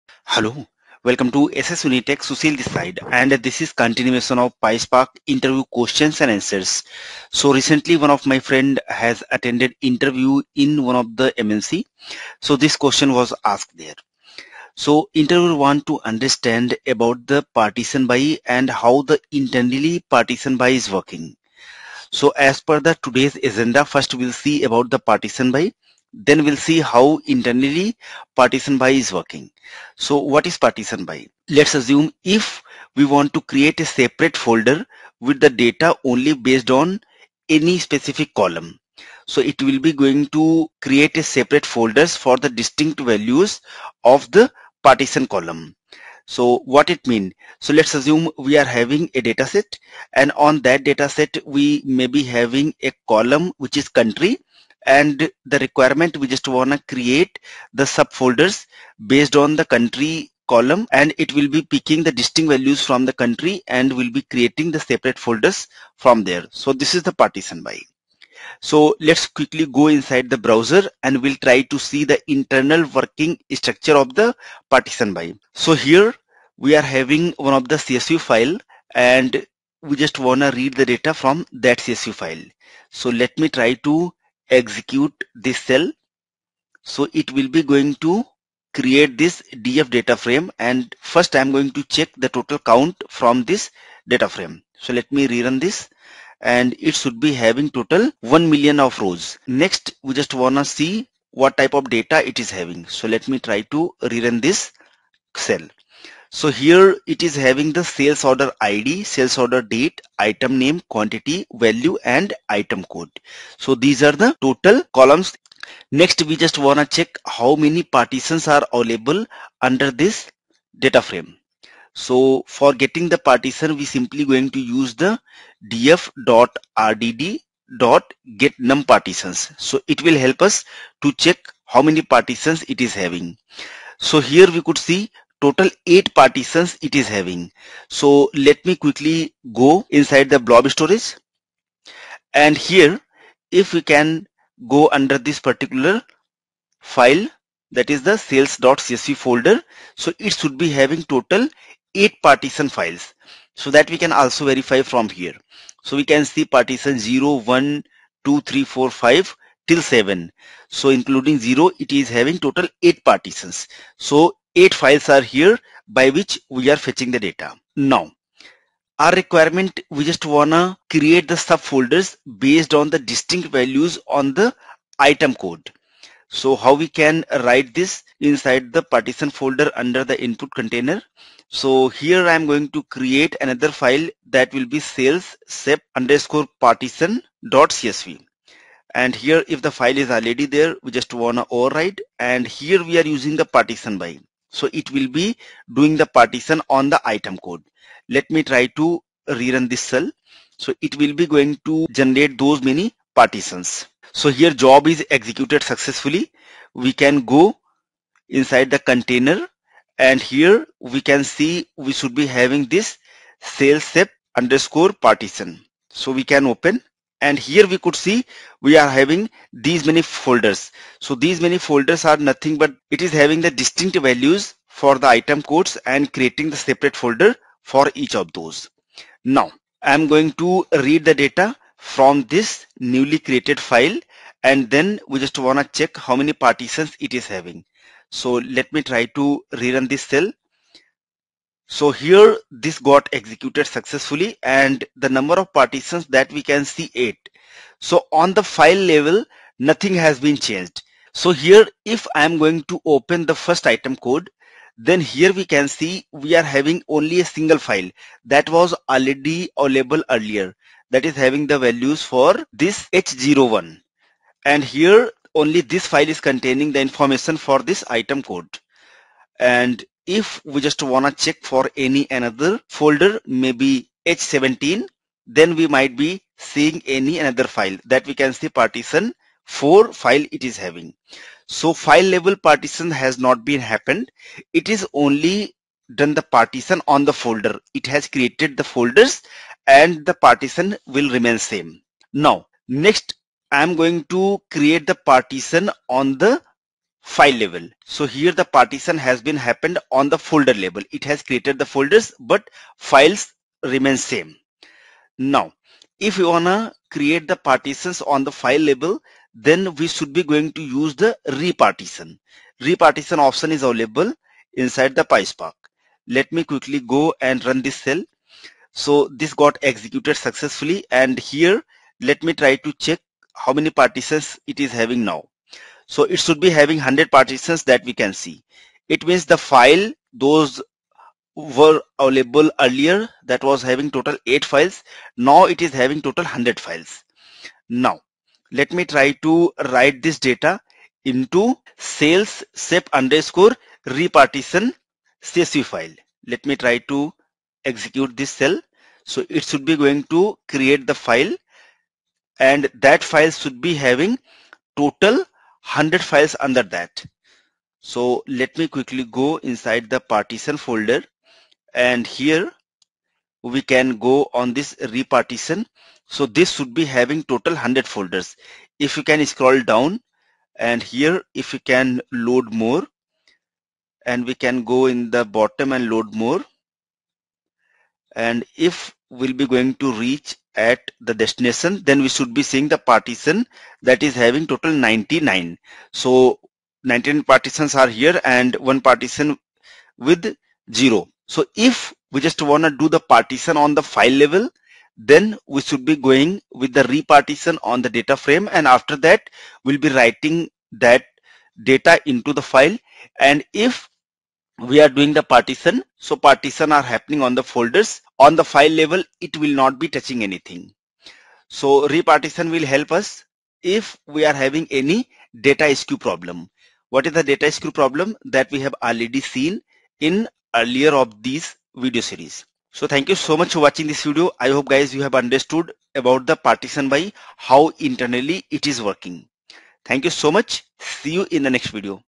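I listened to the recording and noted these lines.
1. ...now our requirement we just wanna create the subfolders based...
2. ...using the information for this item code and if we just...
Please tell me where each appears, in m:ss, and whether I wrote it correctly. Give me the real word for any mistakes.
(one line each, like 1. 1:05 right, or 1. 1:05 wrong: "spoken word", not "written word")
1. 2:47 right
2. 4:26 wrong: "containing", not "using".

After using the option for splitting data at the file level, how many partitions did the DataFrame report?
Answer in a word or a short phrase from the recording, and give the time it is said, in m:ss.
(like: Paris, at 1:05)
100, at 5:26.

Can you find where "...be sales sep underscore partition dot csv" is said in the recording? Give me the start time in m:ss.
3:04.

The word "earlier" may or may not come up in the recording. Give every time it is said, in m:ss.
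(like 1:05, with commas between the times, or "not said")
4:20, 5:32, 7:00.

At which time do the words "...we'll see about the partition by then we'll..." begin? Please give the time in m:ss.
0:24.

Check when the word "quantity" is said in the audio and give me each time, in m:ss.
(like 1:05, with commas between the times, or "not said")
1:50.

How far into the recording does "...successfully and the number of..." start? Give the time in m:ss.
4:03.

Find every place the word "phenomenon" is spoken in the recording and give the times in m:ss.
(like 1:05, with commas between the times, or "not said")
not said.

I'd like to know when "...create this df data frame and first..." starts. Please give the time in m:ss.
1:28.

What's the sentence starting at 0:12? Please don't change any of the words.
So this question was asked there.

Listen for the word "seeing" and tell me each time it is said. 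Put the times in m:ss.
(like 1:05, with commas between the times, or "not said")
4:36, 6:22.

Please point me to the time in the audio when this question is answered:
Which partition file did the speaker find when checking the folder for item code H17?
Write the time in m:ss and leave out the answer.
4:38.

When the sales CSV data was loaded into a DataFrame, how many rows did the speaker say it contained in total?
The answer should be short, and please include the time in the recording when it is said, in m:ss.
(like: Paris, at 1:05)
1 million, at 1:38.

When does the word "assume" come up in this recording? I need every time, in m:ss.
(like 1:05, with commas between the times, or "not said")
0:31, 0:47.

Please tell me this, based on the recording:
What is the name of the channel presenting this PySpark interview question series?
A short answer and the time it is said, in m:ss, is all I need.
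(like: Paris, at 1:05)
SS Unitech, at 0:01.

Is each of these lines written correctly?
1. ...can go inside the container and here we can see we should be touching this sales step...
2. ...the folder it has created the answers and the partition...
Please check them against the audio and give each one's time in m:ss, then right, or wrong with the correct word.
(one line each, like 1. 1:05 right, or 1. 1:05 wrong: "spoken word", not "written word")
1. 3:26 wrong: "having", not "touching"
2. 4:47 wrong: "folders", not "answers".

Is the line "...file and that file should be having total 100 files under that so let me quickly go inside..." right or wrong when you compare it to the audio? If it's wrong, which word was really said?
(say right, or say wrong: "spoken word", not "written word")
right.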